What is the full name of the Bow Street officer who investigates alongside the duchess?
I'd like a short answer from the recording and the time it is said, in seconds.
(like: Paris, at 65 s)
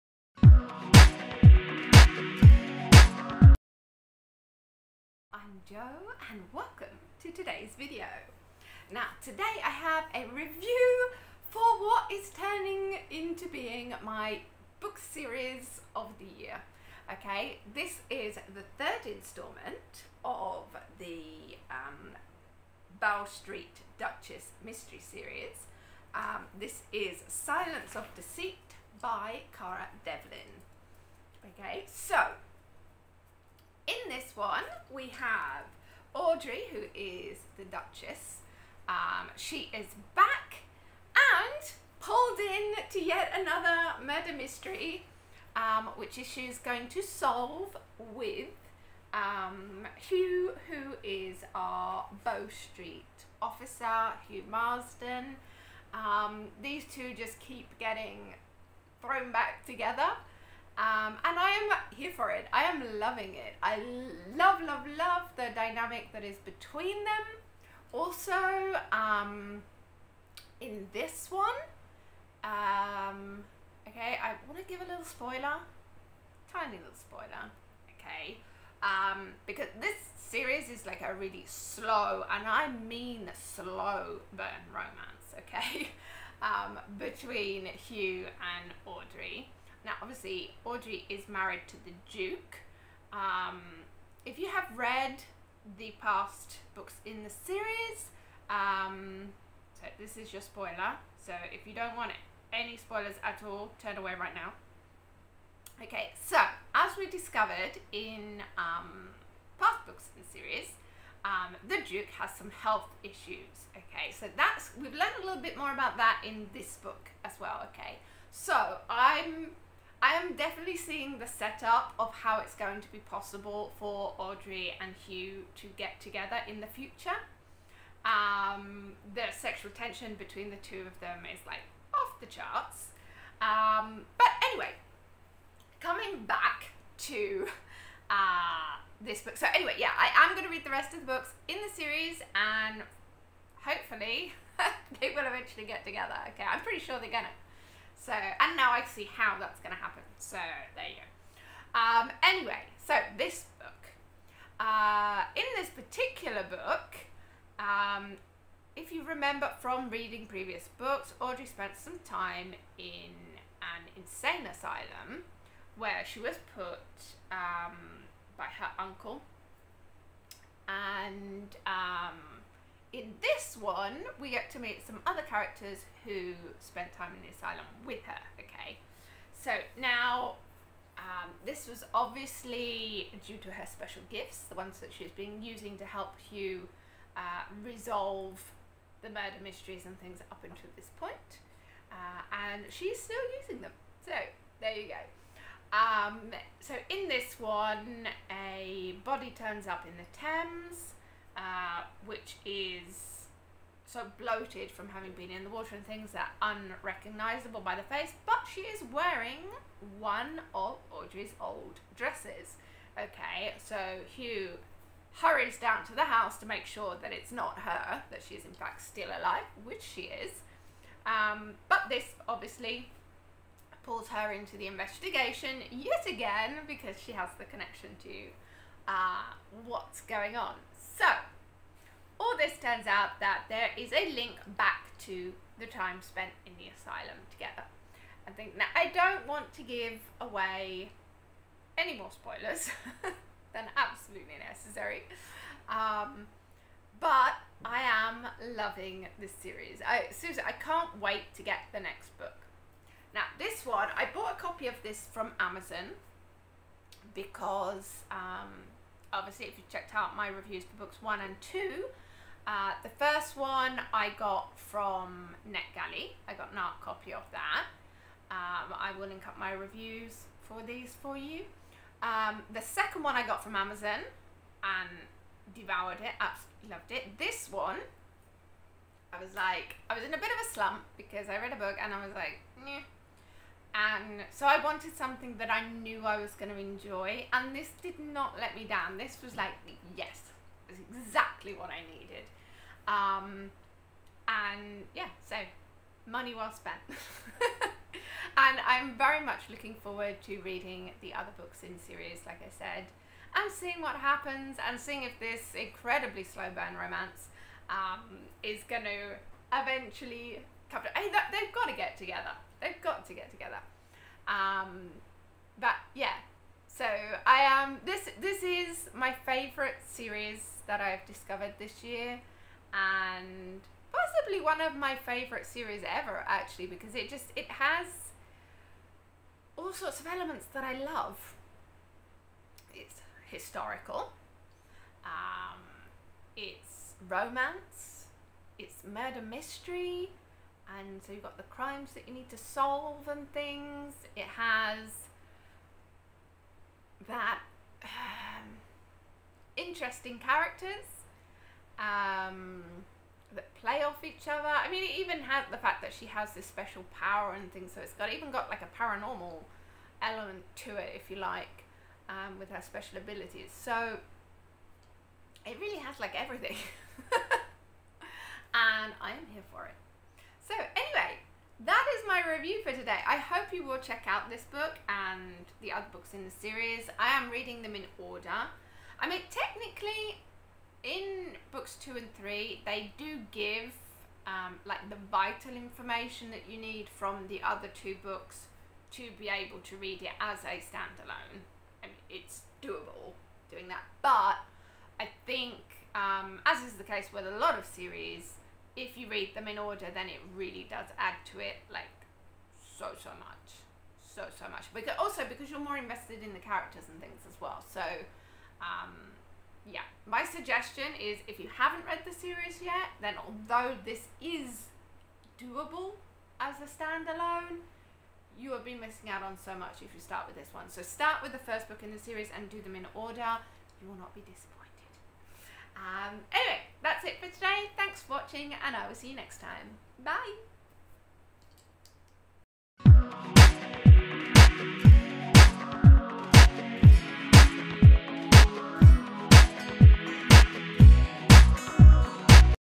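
Hugh Marsden, at 54 s.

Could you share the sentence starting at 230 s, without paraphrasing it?
So, all this turns out that there is a link back to the time spent in the asylum together.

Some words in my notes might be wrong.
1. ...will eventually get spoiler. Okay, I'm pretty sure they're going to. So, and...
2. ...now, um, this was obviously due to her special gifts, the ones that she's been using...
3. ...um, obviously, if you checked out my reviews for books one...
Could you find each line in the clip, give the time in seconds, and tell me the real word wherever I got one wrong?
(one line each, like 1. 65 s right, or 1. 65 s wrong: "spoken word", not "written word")
1. 145 s wrong: "together", not "spoiler"
2. 179 s right
3. 258 s right.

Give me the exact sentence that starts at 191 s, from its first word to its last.
Uh, and she's still using them.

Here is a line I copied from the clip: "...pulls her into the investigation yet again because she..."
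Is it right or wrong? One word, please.
right.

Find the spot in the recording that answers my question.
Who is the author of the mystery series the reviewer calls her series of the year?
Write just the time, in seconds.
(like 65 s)
29 s.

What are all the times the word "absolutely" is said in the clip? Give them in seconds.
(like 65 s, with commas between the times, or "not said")
243 s, 276 s.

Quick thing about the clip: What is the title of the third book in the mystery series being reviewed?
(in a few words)
Silence of Deceit.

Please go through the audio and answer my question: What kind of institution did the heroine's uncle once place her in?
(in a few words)
An insane asylum.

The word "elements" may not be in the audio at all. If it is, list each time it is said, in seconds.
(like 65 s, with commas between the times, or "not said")
330 s, 360 s.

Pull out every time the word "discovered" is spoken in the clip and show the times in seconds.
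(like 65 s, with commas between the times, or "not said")
107 s, 321 s.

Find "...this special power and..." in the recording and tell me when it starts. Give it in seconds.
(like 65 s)
356 s.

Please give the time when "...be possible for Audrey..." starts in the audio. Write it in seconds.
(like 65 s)
122 s.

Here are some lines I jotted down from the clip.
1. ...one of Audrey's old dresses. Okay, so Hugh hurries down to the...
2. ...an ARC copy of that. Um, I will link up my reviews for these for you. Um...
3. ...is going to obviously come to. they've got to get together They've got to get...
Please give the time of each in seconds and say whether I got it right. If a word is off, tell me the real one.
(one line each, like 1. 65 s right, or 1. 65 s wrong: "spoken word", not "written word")
1. 209 s right
2. 266 s right
3. 308 s wrong: "eventually", not "obviously".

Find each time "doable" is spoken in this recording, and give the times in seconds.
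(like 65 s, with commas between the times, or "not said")
392 s, 415 s.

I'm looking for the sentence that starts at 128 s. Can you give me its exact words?
Um, the sexual tension between the two of them is like off the charts.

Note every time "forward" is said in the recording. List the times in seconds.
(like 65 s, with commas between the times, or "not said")
299 s.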